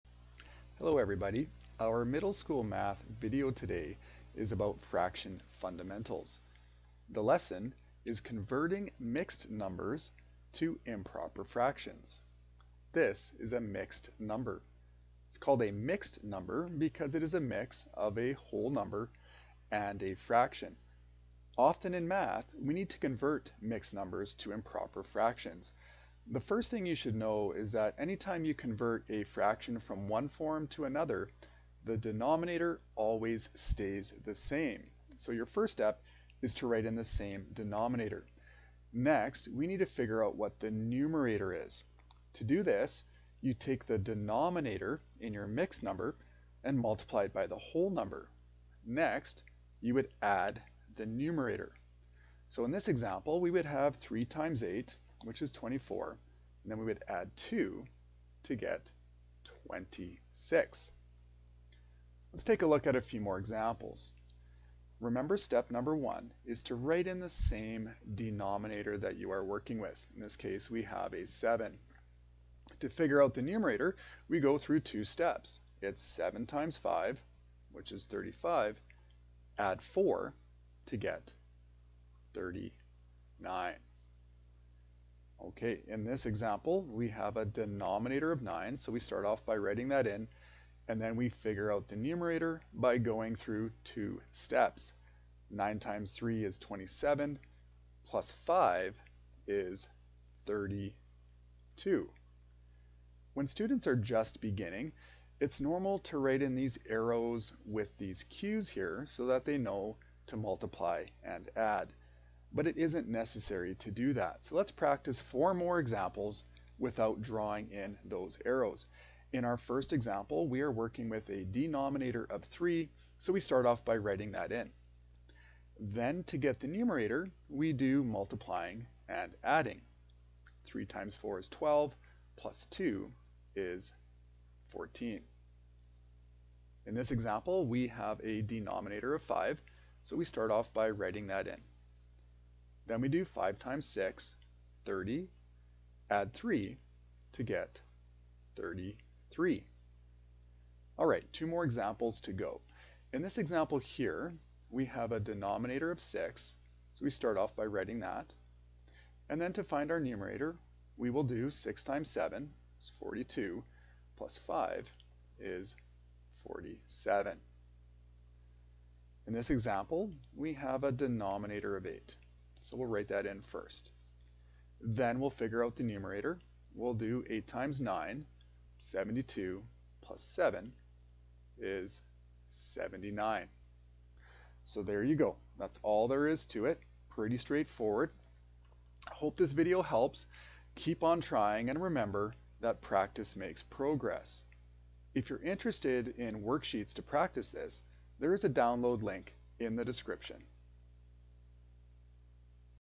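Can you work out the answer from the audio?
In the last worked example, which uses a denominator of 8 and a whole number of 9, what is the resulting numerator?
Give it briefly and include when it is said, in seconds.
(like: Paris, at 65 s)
79, at 182 s.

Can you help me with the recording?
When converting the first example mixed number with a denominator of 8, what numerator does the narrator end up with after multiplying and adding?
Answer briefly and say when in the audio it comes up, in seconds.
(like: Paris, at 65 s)
26, at 59 s.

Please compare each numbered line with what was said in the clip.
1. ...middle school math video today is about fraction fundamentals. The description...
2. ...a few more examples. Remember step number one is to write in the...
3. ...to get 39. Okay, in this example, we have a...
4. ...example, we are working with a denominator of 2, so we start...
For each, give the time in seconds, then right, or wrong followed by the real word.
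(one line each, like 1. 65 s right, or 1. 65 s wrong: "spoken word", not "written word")
1. 2 s wrong: "lesson", not "description"
2. 62 s right
3. 80 s right
4. 119 s wrong: "3", not "2".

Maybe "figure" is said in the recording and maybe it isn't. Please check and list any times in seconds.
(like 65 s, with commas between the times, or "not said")
39 s, 72 s, 91 s, 175 s.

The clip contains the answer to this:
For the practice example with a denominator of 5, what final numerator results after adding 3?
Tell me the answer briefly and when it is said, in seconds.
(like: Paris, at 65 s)
33, at 148 s.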